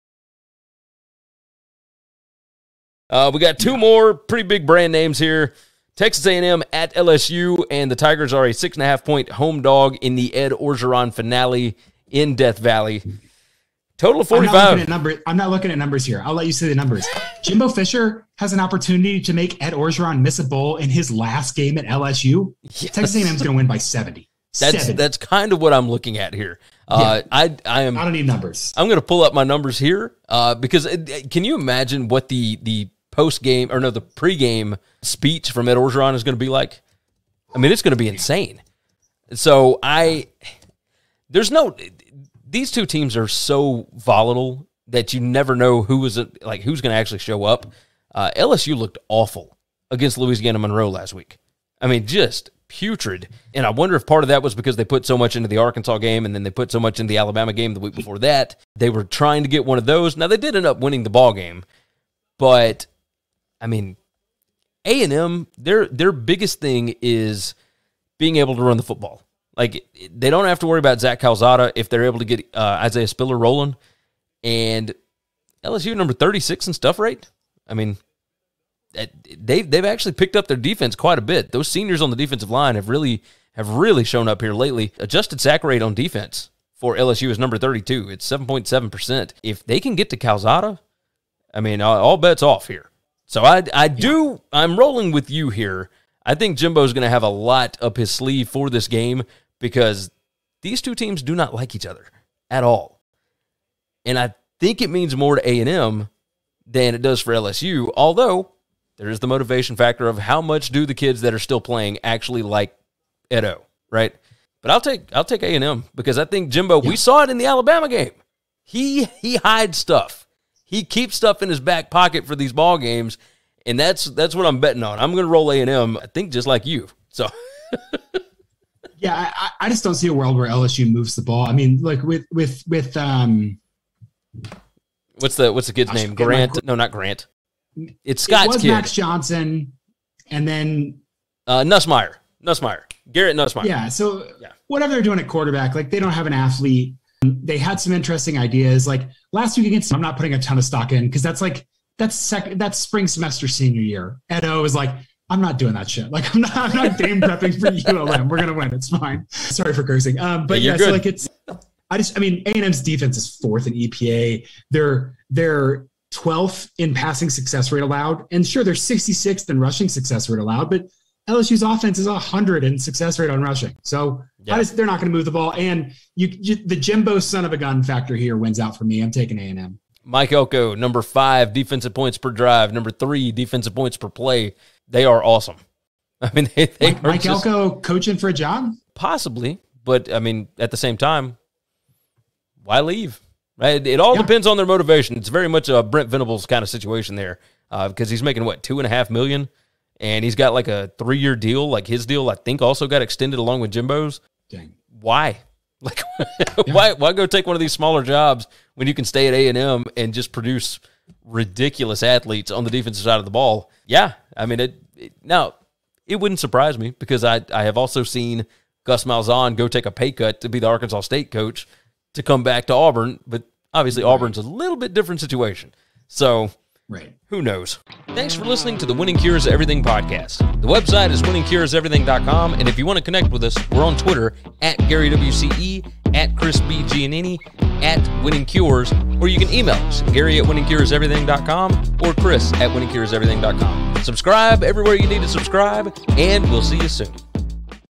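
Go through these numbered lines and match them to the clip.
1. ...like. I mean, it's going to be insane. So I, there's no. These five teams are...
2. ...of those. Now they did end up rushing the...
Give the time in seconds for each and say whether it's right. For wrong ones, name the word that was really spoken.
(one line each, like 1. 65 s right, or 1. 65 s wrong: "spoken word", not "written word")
1. 36 s wrong: "two", not "five"
2. 59 s wrong: "winning", not "rushing".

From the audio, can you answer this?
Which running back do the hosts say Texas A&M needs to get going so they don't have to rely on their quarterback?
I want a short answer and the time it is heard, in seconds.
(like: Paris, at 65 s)
Isaiah Spiller, at 72 s.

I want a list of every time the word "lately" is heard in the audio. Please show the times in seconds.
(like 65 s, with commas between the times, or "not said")
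84 s.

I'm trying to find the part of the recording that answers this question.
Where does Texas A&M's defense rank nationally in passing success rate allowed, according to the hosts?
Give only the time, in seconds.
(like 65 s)
166 s.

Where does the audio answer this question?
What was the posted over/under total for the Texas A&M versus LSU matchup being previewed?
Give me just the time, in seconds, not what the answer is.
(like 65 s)
13 s.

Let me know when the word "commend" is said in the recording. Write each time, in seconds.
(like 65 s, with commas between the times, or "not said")
not said.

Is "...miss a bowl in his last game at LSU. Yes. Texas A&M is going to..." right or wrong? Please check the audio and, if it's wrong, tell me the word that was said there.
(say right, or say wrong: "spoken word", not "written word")
right.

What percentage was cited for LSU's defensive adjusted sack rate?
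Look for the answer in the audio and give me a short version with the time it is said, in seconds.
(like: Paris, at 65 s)
7.7%, at 88 s.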